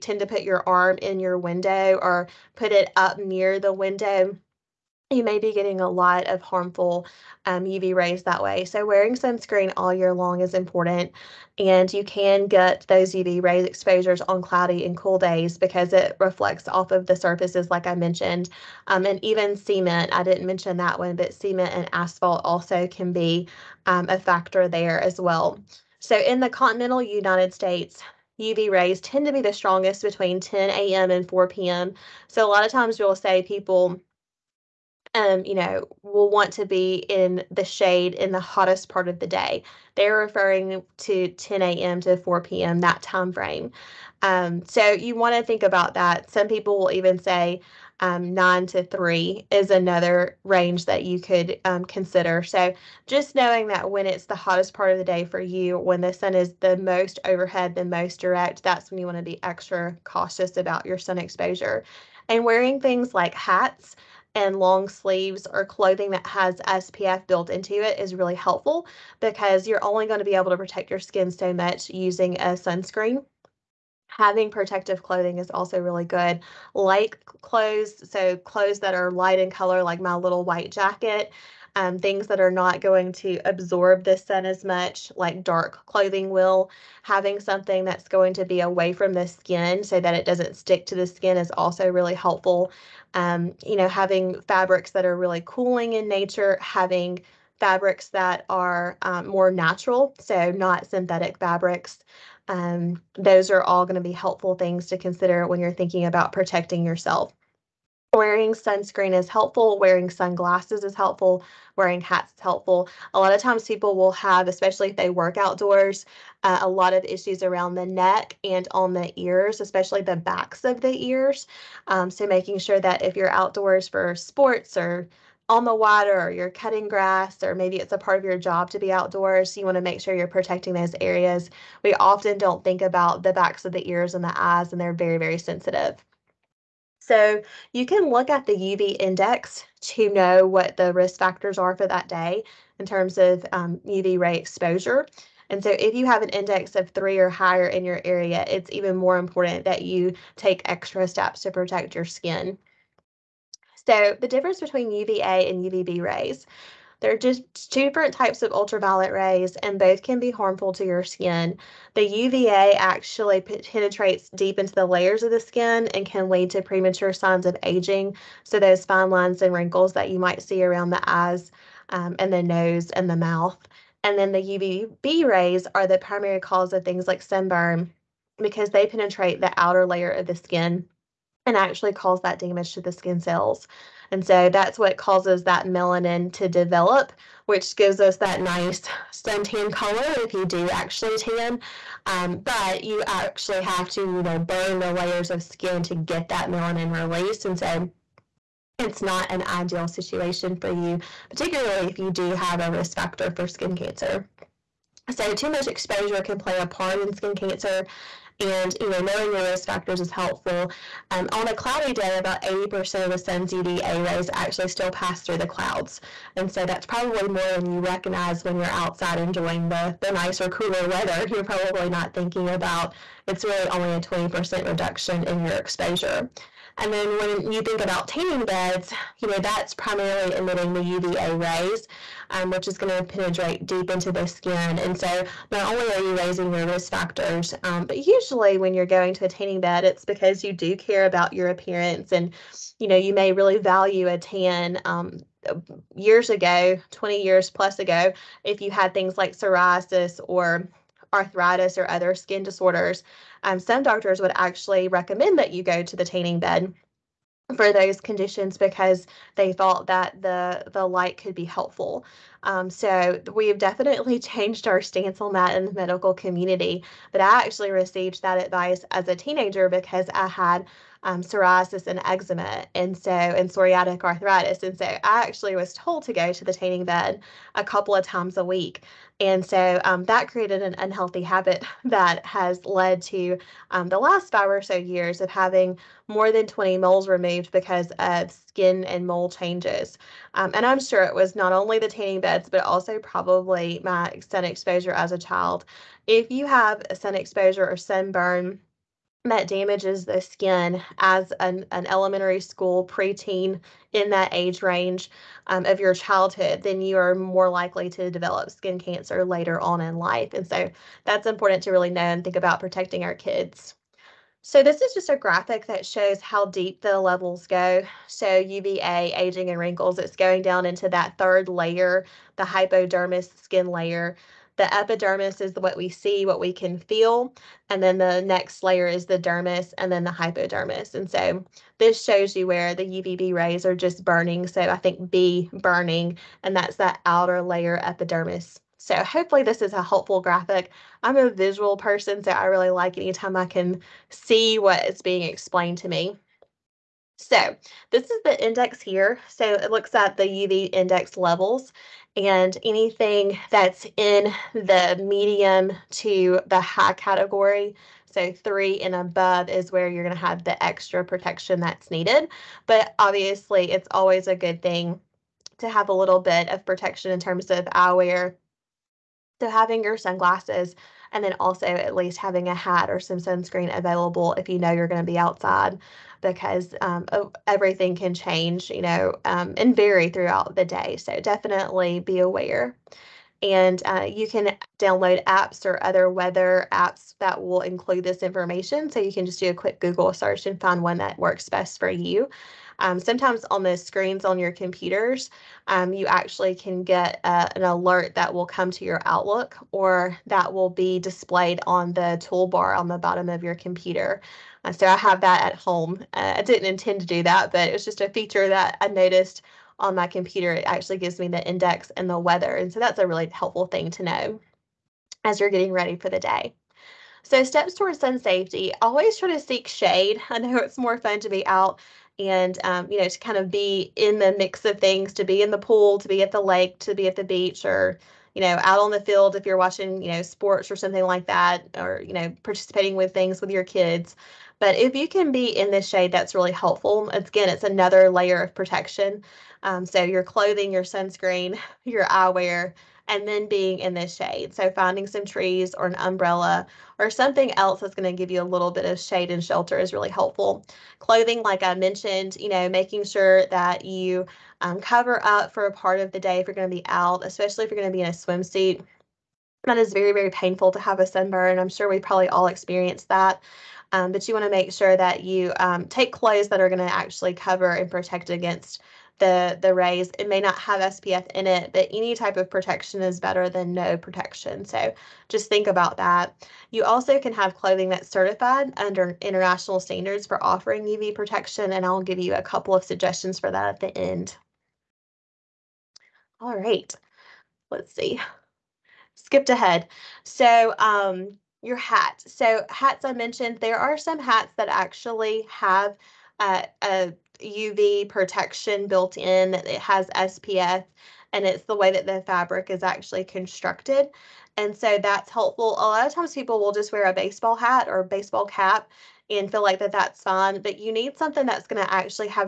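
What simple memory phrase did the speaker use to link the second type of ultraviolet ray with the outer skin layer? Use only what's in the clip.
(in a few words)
B burning.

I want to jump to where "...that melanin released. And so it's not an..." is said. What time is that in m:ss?
3:16.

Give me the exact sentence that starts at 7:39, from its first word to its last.
That is very, very painful to have a sunburn.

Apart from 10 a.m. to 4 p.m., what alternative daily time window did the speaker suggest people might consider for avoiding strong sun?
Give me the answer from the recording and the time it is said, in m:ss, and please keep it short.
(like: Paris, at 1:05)
9 to 3, at 0:48.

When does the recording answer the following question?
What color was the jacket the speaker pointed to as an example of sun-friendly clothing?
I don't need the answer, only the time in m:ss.
1:20.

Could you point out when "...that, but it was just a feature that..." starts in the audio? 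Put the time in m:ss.
6:47.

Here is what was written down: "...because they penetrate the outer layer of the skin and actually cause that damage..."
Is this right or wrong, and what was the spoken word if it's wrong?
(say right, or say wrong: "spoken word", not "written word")
right.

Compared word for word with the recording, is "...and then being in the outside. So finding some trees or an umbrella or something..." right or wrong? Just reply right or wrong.
wrong.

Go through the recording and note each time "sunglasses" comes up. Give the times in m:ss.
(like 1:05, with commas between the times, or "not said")
1:50, 6:09.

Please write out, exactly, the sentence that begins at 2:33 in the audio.
So the difference between UVA and UVB rays.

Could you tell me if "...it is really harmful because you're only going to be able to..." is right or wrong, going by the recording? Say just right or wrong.
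wrong.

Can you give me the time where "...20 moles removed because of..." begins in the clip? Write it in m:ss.
4:46.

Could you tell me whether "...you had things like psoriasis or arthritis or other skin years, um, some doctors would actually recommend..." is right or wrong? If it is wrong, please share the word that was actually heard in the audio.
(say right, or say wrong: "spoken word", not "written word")
wrong: "disorders", not "years".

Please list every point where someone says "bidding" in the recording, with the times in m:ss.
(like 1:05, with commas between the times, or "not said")
not said.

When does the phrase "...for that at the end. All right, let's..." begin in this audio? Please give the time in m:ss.
8:03.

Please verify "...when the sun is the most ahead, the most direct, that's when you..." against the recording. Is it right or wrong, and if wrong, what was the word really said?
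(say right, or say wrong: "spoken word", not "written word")
wrong: "overhead", not "ahead".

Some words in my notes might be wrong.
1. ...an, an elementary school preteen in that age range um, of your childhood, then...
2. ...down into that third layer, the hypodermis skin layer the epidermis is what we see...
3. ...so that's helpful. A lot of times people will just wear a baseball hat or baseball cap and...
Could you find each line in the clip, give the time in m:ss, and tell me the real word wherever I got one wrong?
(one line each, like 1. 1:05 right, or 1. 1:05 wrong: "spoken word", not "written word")
1. 5:01 right
2. 5:20 right
3. 8:24 right.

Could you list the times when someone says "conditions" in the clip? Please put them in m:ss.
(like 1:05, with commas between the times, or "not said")
4:18.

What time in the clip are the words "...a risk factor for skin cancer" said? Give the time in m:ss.
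3:22.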